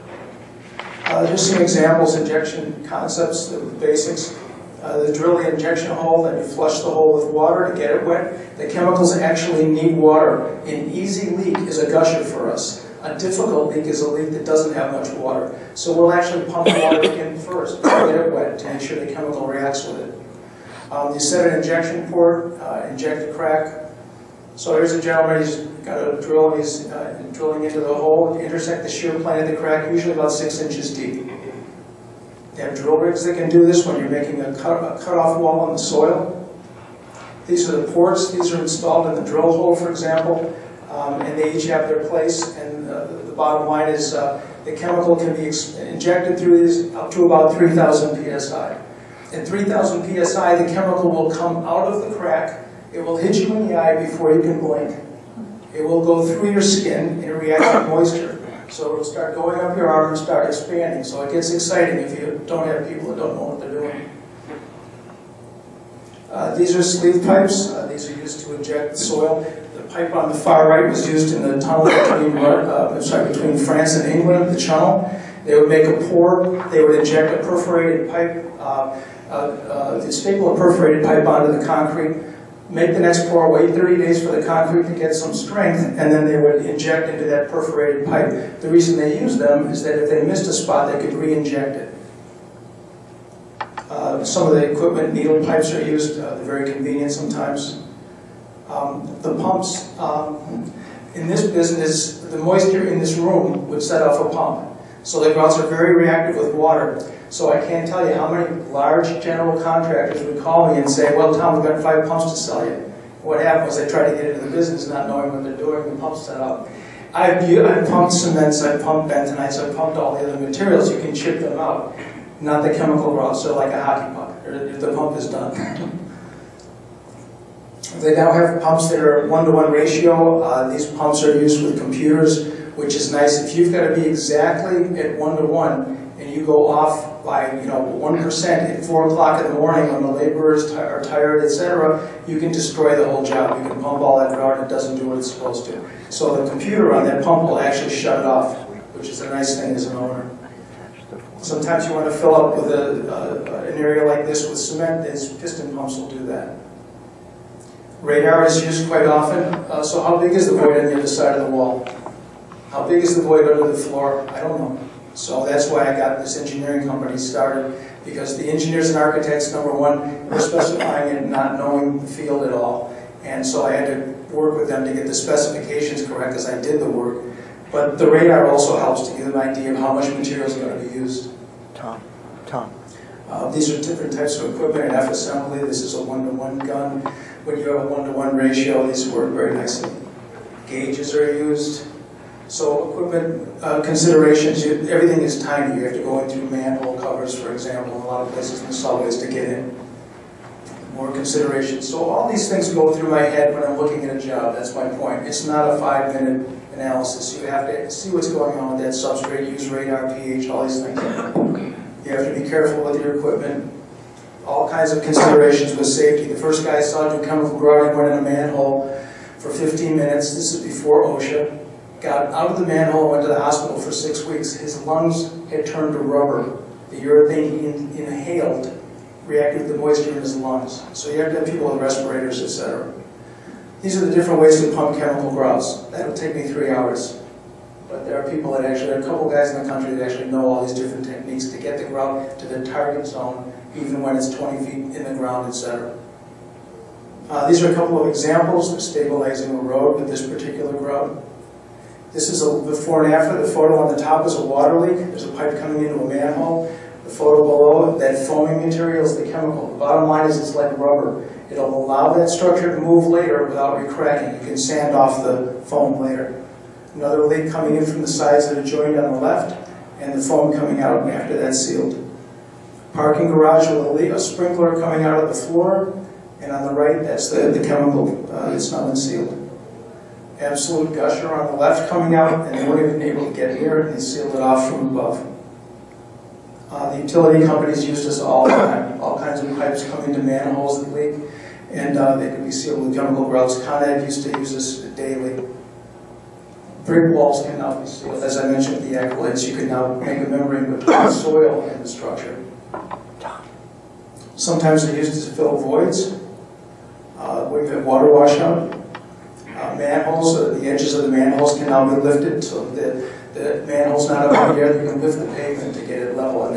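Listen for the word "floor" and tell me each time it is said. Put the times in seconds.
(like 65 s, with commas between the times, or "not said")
163 s, 275 s.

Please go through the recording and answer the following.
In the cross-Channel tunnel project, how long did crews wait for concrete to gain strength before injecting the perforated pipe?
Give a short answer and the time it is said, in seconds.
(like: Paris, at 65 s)
30 days, at 83 s.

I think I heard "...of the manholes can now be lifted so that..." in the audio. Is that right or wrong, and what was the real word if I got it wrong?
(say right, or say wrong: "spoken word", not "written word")
right.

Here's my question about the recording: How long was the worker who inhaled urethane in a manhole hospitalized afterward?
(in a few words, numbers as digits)
6 weeks.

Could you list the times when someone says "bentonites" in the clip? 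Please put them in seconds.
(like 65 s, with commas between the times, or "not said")
119 s.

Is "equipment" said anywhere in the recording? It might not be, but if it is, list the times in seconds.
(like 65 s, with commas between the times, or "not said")
94 s, 184 s, 192 s, 213 s.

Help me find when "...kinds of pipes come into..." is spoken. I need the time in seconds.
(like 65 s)
289 s.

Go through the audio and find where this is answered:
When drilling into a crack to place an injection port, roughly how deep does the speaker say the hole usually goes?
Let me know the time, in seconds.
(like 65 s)
30 s.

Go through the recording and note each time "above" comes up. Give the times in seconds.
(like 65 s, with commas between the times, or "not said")
284 s.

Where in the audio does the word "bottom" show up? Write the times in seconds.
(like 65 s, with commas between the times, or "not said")
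43 s, 259 s.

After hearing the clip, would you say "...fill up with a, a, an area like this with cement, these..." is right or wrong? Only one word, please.
right.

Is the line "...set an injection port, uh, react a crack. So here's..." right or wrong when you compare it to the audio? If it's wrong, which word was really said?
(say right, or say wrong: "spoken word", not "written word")
wrong: "inject", not "react".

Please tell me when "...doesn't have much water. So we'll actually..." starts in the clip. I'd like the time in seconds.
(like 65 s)
14 s.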